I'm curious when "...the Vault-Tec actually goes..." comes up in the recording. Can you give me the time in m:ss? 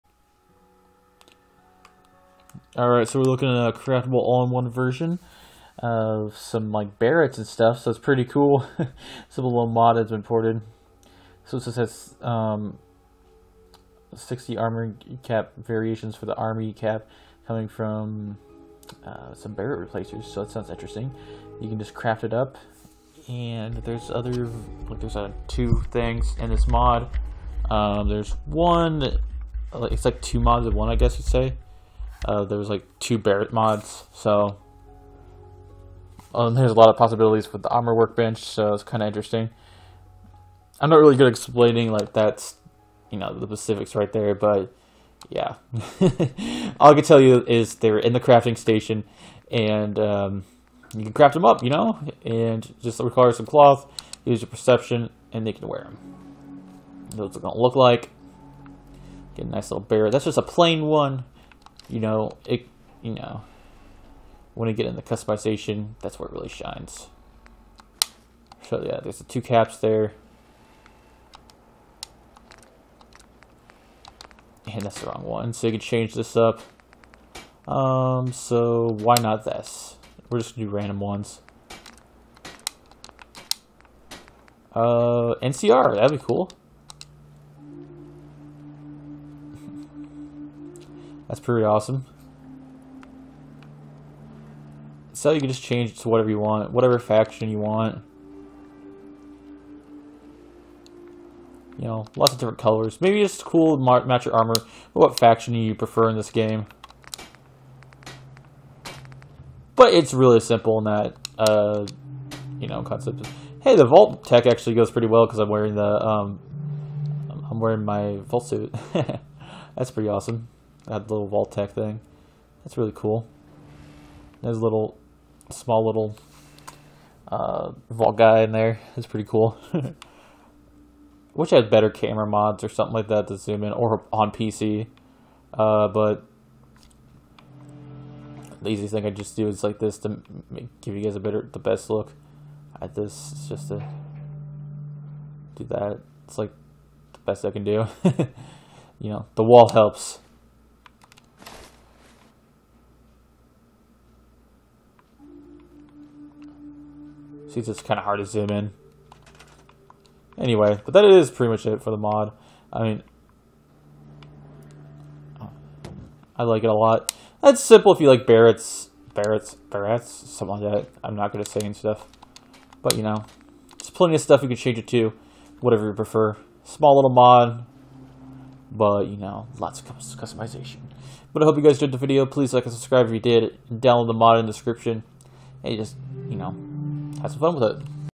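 1:53.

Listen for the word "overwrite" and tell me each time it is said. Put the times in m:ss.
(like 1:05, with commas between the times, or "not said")
not said.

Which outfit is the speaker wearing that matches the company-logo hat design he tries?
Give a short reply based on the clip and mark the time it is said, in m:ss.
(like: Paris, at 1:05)
Vault suit, at 1:58.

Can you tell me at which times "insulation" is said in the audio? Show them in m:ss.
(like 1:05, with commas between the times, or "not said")
not said.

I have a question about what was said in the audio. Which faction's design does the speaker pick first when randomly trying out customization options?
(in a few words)
NCR.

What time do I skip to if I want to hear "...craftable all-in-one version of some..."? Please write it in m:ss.
0:03.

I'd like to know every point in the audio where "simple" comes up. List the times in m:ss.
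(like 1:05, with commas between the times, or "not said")
1:50, 2:47.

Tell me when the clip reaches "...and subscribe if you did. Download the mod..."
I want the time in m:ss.
3:02.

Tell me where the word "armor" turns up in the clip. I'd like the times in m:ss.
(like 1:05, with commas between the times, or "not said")
0:14, 0:37, 1:44.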